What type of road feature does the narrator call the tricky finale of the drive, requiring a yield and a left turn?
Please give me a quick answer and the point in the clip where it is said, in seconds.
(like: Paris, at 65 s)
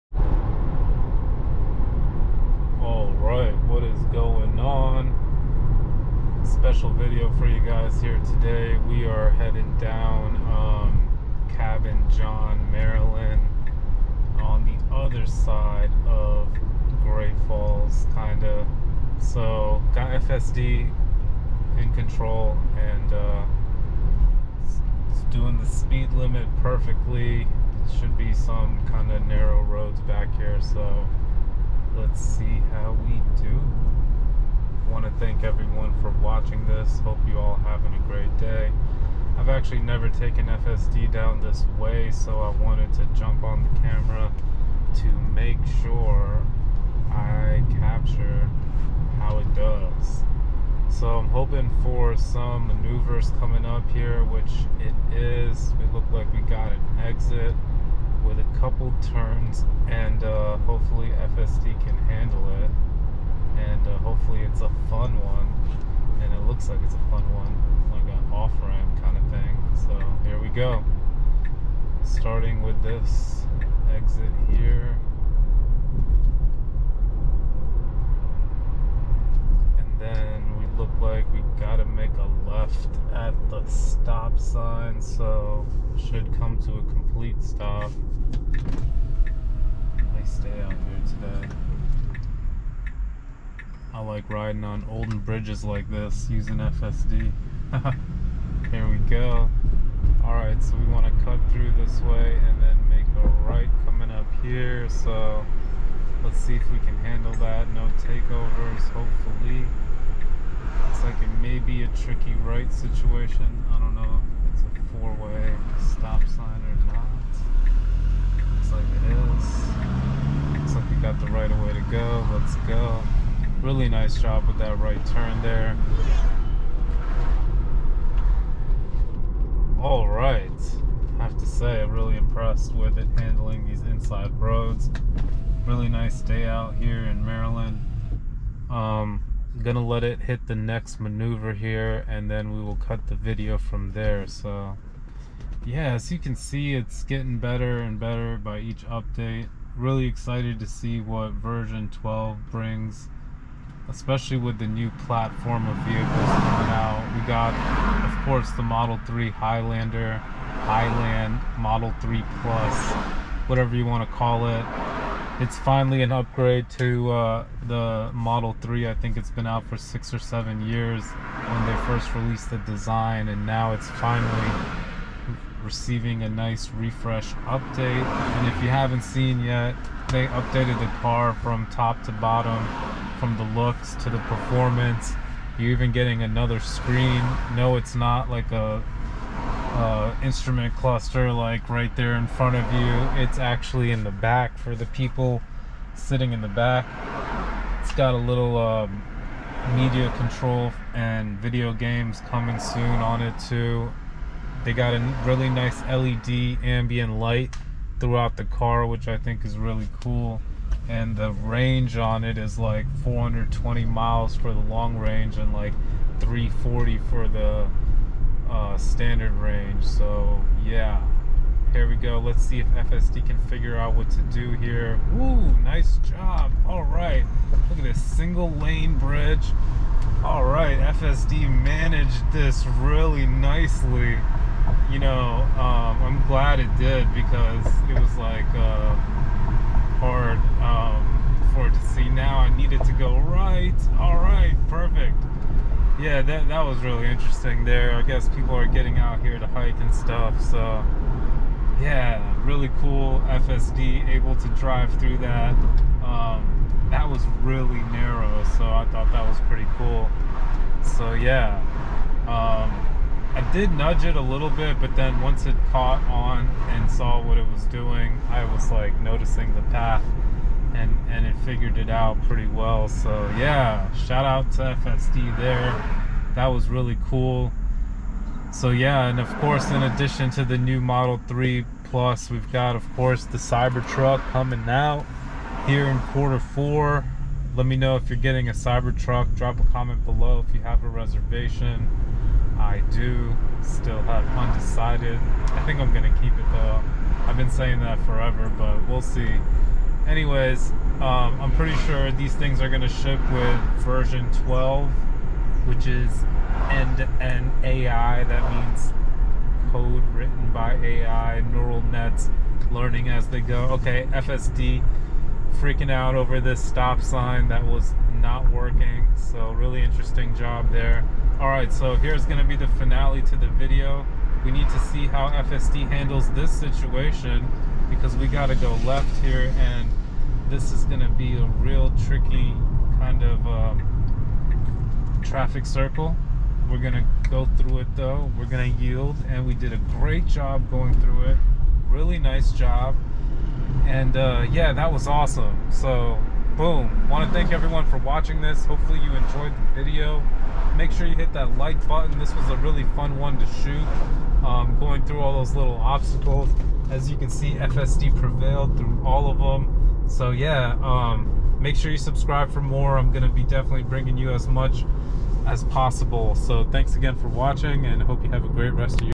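traffic circle, at 335 s.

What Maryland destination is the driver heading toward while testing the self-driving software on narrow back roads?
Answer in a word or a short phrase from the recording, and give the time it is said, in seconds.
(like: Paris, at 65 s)
Cabin John, at 11 s.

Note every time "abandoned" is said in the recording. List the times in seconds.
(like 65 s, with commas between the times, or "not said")
not said.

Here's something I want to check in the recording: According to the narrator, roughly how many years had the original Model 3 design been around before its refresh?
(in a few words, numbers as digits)
six or seven.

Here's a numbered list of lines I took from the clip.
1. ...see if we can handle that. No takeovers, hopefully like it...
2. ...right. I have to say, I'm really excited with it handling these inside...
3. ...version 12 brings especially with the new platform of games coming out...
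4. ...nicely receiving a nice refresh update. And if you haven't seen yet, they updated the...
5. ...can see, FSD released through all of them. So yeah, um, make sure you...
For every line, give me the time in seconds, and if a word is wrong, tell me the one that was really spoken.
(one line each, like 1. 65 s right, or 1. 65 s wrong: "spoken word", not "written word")
1. 106 s right
2. 130 s wrong: "impressed", not "excited"
3. 151 s wrong: "vehicles", not "games"
4. 173 s wrong: "finally", not "nicely"
5. 357 s wrong: "prevailed", not "released".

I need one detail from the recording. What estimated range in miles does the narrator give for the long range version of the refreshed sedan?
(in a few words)
420.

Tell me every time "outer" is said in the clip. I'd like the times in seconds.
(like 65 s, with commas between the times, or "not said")
not said.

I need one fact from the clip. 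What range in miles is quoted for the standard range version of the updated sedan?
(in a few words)
340.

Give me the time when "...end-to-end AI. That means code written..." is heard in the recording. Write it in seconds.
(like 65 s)
306 s.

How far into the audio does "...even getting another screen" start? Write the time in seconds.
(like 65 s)
185 s.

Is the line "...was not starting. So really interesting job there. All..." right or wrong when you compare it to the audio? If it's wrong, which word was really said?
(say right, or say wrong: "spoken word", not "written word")
wrong: "working", not "starting".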